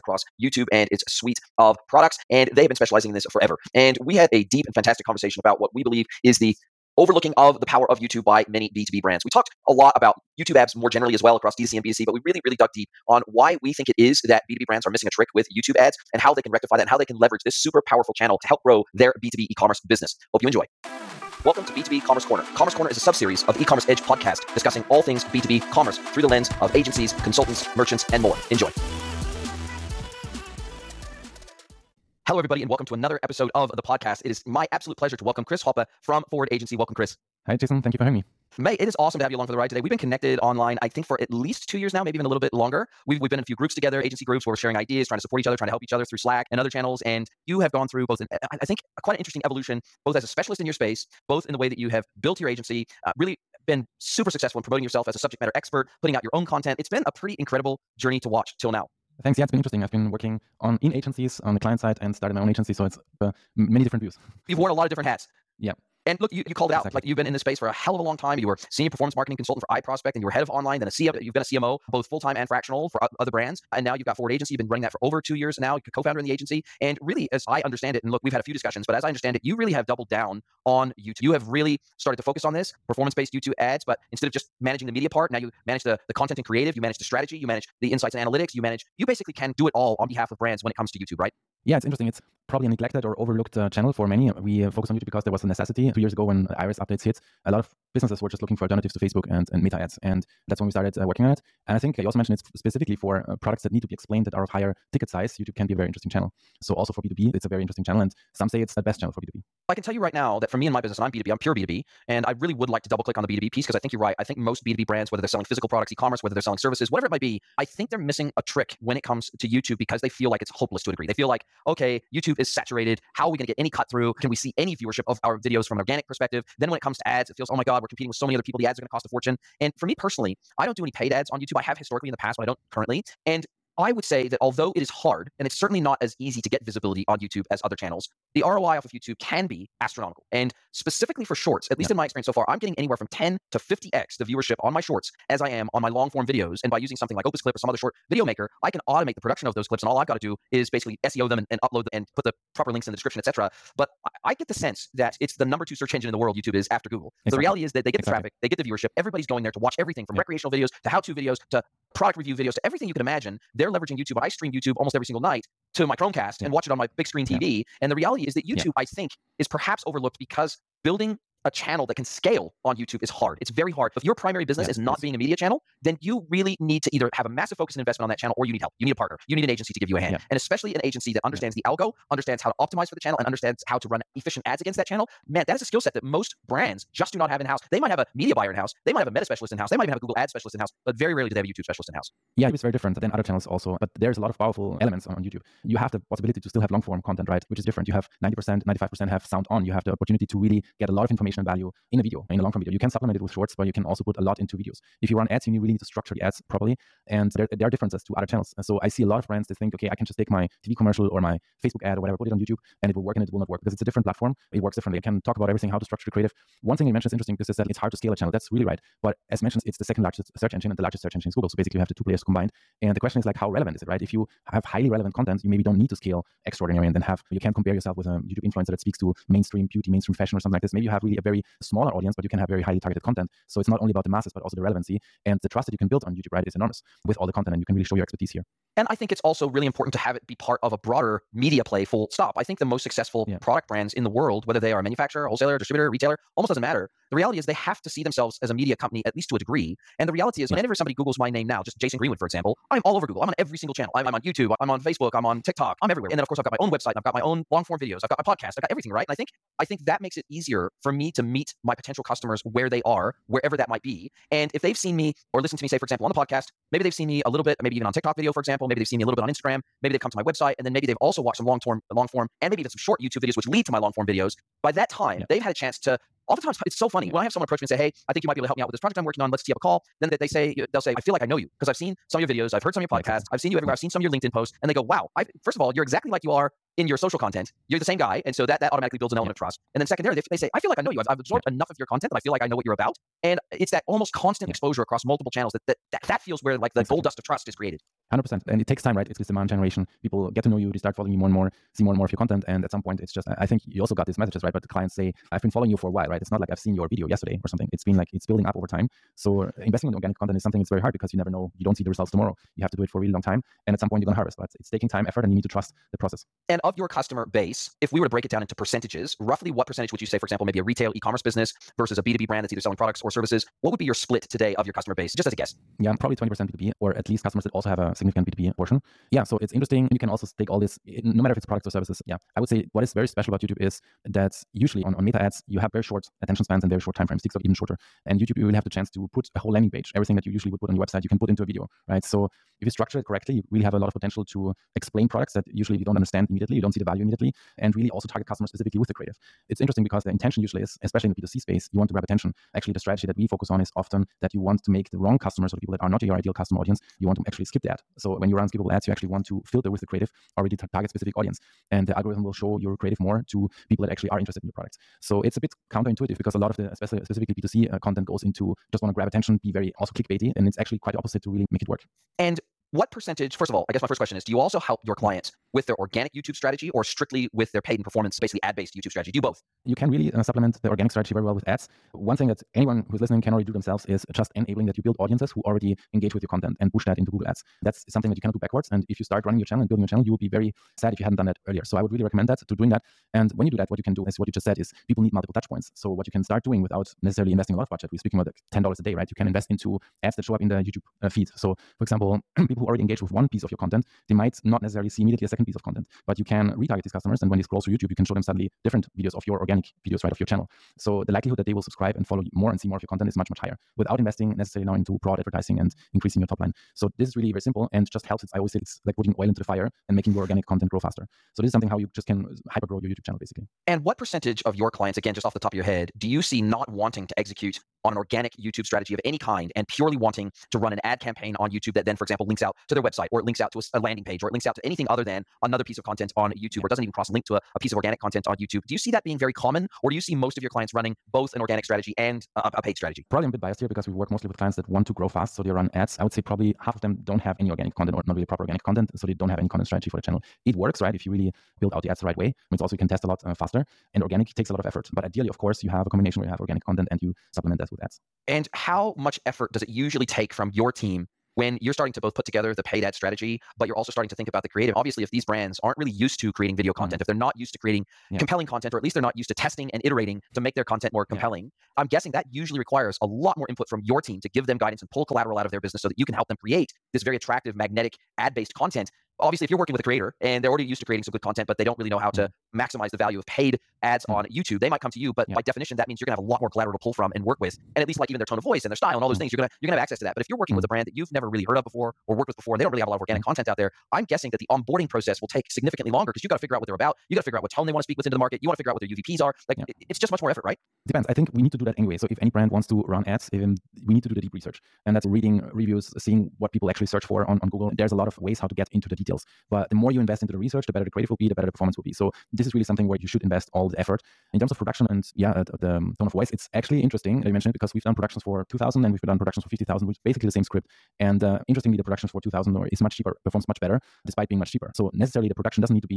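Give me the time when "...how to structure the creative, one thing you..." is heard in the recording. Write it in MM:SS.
03:35.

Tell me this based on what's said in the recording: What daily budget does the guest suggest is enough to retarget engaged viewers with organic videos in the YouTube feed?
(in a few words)
$10 a day.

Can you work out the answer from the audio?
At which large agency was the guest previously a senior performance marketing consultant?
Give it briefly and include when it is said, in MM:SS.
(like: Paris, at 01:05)
iProspect, at 01:09.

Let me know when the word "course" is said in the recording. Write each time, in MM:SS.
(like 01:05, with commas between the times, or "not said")
04:16, 07:35.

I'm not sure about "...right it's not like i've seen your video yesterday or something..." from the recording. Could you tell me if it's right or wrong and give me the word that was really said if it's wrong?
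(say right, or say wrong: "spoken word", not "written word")
right.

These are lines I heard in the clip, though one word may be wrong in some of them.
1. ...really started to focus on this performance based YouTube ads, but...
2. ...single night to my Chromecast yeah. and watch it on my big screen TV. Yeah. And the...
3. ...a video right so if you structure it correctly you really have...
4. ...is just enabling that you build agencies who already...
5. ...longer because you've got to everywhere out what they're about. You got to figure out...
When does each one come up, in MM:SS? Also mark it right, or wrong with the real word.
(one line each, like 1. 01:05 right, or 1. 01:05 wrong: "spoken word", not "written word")
1. 01:21 right
2. 02:45 right
3. 05:41 right
4. 06:23 wrong: "audiences", not "agencies"
5. 08:15 wrong: "figure", not "everywhere".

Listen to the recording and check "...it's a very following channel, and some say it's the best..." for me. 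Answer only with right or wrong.
wrong.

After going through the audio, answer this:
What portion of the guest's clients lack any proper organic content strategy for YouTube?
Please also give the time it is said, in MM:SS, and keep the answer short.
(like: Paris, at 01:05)
half, at 07:26.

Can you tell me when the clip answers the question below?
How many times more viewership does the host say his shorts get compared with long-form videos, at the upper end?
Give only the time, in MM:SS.
02:23.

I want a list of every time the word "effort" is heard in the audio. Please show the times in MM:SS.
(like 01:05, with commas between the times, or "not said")
05:15, 07:34, 07:39, 08:20, 08:33.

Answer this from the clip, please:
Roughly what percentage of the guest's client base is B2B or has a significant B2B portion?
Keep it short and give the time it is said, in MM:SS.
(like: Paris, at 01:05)
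20%, at 05:26.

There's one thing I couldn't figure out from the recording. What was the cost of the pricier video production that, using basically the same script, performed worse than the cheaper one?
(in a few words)
50000.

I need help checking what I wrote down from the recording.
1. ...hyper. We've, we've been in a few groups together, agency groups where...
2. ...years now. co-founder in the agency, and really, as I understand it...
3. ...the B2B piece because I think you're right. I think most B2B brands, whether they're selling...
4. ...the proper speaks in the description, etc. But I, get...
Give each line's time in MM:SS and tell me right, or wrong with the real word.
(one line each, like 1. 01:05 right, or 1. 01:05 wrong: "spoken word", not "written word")
1. 00:42 wrong: "longer", not "hyper"
2. 01:15 right
3. 01:53 right
4. 02:32 wrong: "links", not "speaks".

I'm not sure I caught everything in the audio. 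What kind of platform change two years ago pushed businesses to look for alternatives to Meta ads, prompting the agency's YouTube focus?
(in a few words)
iOS updates.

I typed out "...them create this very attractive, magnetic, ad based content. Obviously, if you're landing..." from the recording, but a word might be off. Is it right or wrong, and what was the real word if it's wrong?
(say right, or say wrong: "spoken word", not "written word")
wrong: "working", not "landing".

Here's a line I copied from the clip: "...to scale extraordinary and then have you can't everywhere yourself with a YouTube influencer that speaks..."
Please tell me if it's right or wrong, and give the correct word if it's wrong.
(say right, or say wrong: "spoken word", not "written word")
wrong: "compare", not "everywhere".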